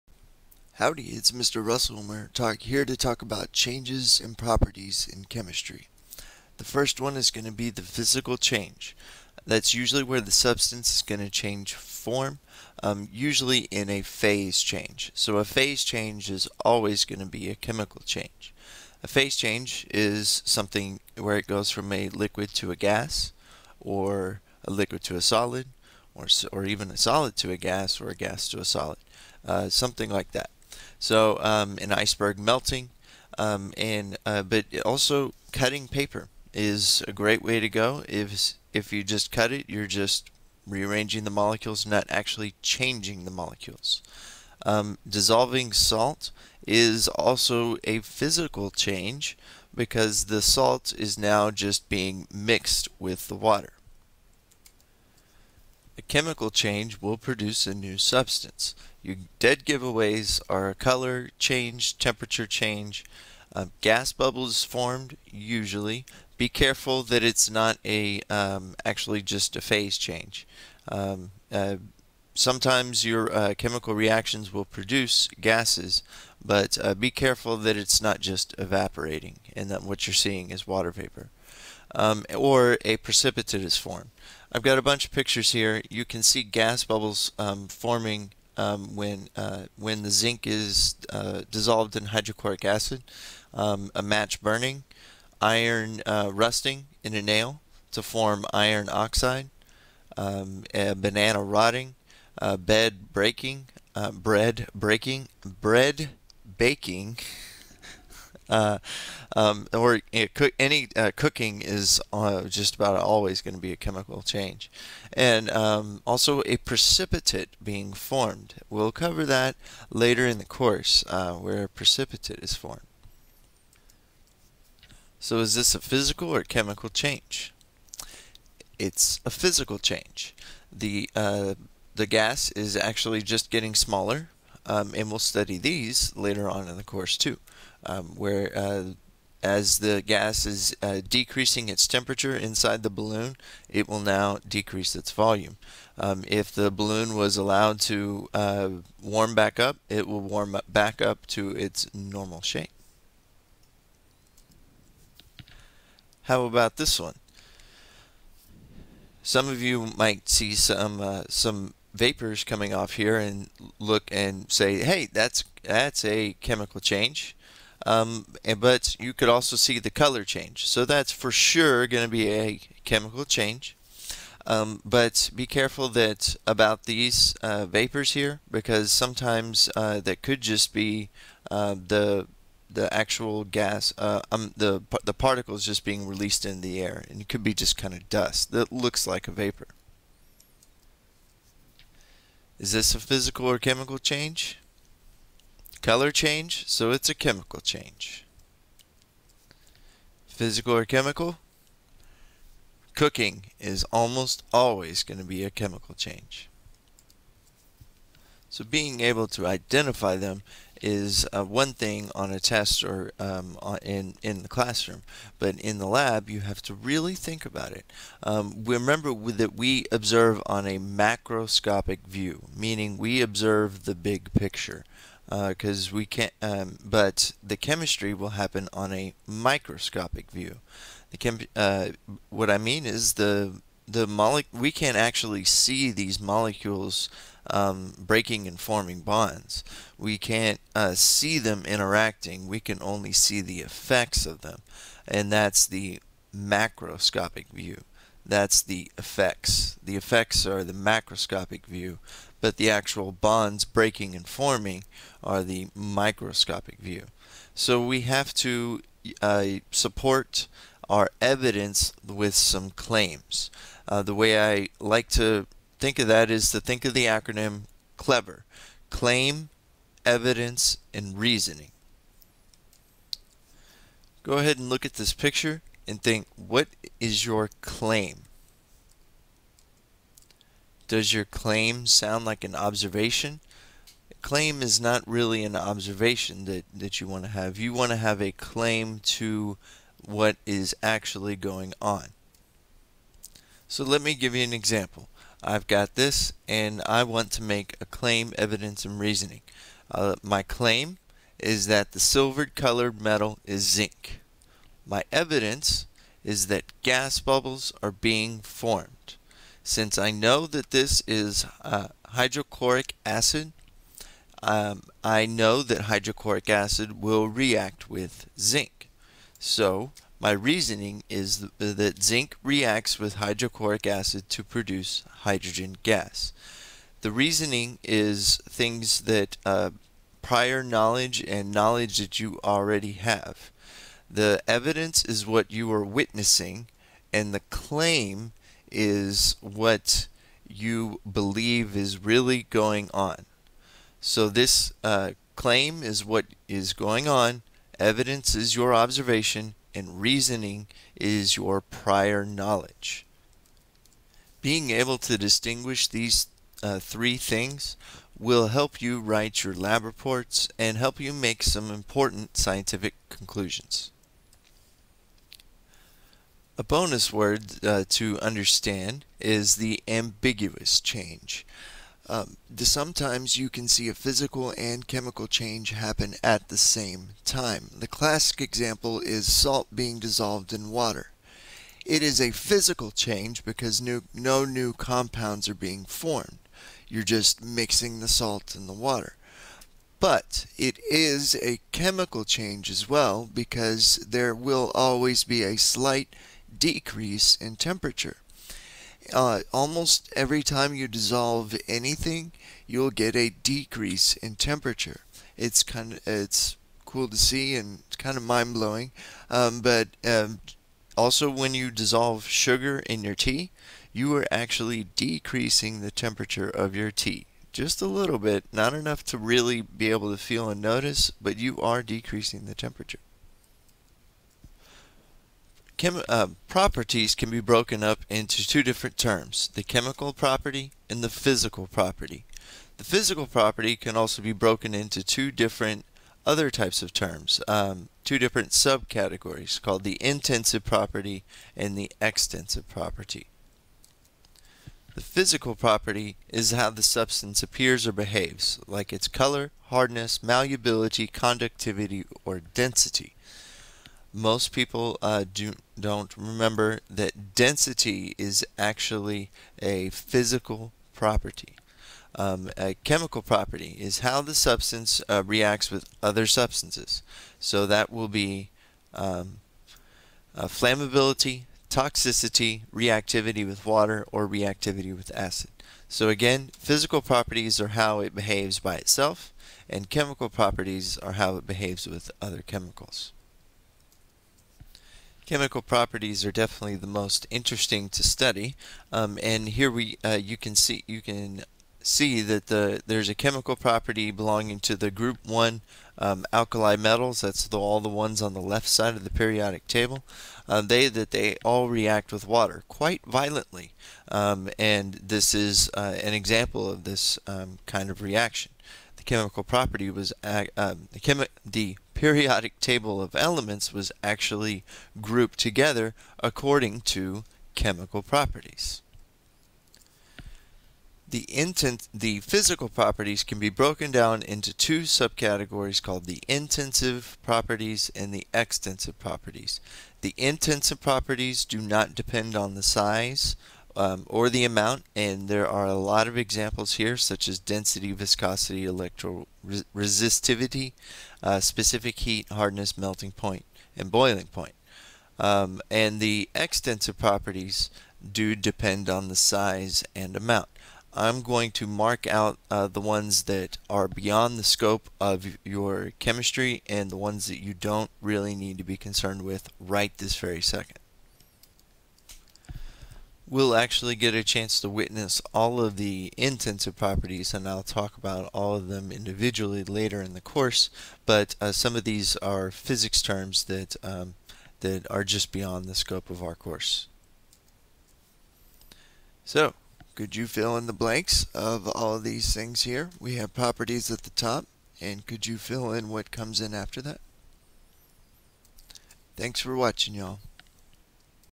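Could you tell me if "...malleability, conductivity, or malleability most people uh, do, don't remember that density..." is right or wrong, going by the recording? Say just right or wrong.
wrong.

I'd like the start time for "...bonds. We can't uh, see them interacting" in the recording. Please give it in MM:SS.
03:59.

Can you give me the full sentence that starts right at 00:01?
Russell talk, here to talk about changes and properties in chemistry.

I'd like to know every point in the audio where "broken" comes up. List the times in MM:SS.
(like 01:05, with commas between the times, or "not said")
07:07, 07:14, 08:43.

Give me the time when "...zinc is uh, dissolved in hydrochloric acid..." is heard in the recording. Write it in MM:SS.
01:30.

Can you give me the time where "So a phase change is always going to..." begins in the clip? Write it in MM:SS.
00:15.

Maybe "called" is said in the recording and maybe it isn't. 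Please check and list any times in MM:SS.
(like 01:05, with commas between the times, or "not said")
07:19, 08:45.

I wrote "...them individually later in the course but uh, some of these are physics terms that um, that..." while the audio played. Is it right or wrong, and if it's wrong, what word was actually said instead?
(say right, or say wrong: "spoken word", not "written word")
right.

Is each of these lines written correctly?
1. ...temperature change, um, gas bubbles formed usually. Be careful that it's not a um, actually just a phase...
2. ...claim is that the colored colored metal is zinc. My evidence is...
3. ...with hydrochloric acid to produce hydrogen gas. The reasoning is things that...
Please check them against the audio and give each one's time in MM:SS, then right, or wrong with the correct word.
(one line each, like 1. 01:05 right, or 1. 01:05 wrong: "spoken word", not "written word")
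1. 01:01 right
2. 05:00 wrong: "silvered", not "colored"
3. 05:22 right.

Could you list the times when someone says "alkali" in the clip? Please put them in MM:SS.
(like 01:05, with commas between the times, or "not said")
08:16.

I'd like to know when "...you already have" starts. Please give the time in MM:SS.
05:32.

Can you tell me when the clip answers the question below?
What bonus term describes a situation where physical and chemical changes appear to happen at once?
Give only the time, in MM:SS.
06:09.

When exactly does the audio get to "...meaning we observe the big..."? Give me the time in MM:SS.
03:42.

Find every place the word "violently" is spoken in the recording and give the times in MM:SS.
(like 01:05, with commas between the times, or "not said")
08:23.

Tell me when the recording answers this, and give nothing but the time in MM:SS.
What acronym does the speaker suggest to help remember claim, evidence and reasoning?
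04:27.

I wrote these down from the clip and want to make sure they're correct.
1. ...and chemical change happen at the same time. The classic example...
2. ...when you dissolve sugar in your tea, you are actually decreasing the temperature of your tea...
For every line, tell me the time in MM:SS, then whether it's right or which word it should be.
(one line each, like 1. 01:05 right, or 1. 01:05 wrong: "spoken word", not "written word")
1. 06:14 right
2. 06:51 right.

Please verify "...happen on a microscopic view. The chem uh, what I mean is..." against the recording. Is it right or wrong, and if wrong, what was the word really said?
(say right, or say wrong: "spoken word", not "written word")
right.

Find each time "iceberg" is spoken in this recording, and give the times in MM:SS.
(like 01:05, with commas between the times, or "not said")
00:31.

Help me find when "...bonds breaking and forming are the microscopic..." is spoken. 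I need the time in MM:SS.
04:13.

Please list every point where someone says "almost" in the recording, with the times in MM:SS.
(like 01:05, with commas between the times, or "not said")
03:23, 06:39.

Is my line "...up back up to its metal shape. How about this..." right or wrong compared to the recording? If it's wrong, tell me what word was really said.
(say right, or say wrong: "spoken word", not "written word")
wrong: "normal", not "metal".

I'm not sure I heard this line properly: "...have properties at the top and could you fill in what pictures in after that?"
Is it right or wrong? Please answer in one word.
wrong.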